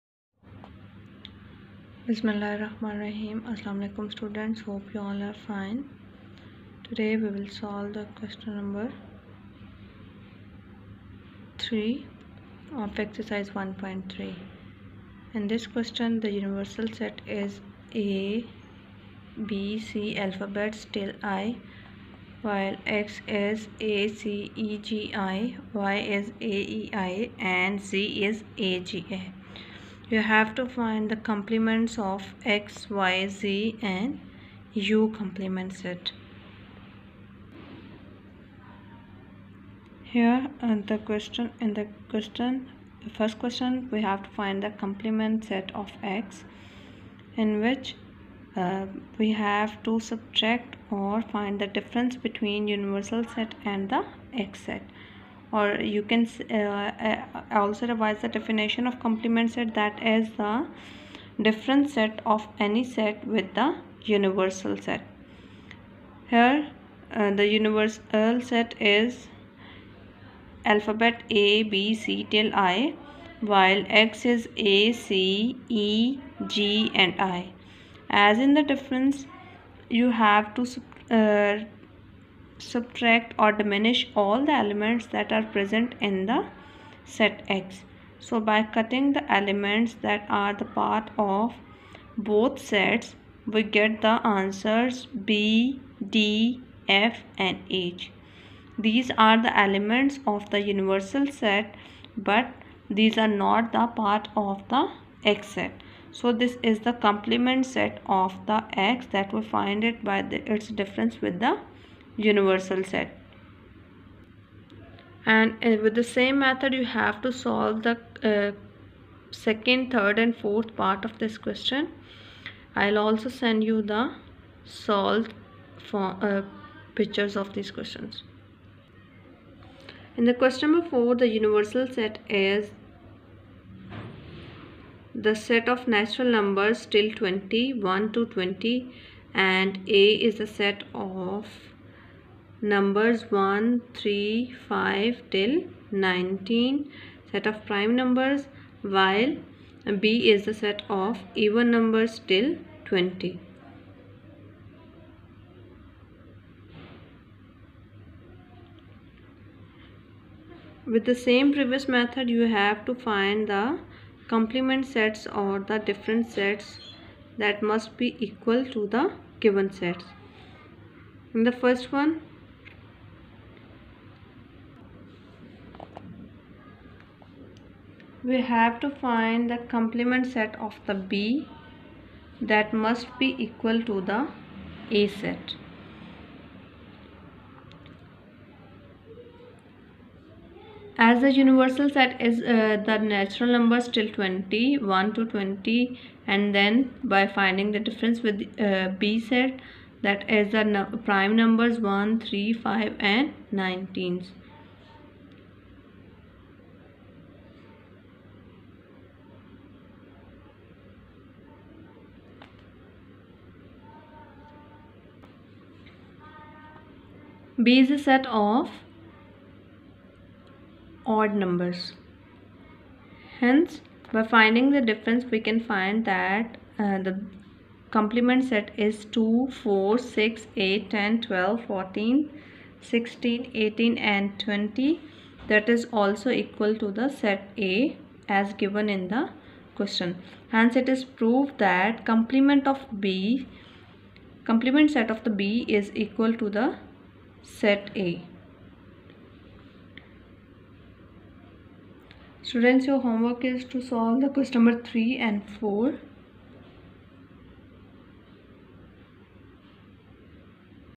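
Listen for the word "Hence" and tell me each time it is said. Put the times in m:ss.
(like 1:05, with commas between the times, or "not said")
3:43, 4:00.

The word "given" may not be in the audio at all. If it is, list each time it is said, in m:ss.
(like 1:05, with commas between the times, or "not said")
2:49, 3:58.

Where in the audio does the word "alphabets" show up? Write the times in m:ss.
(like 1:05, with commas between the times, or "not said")
0:20, 1:10.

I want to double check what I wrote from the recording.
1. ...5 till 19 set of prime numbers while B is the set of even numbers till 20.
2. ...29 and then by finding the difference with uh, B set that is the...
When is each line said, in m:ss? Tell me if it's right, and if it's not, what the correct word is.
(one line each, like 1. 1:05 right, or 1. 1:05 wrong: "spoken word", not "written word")
1. 2:24 right
2. 3:15 wrong: "20", not "29".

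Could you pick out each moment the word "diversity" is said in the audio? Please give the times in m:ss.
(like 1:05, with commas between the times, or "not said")
not said.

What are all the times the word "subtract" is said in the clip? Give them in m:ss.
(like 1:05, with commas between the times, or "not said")
0:50, 1:22.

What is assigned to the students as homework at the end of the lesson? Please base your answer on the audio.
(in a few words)
Questions 3 and 4.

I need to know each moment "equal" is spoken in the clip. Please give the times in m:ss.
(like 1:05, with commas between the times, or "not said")
2:48, 3:03, 3:56, 4:05.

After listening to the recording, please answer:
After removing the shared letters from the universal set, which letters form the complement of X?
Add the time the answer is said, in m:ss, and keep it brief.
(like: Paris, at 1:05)
B, D, F and H, at 1:35.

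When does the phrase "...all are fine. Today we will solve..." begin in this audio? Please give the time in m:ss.
0:05.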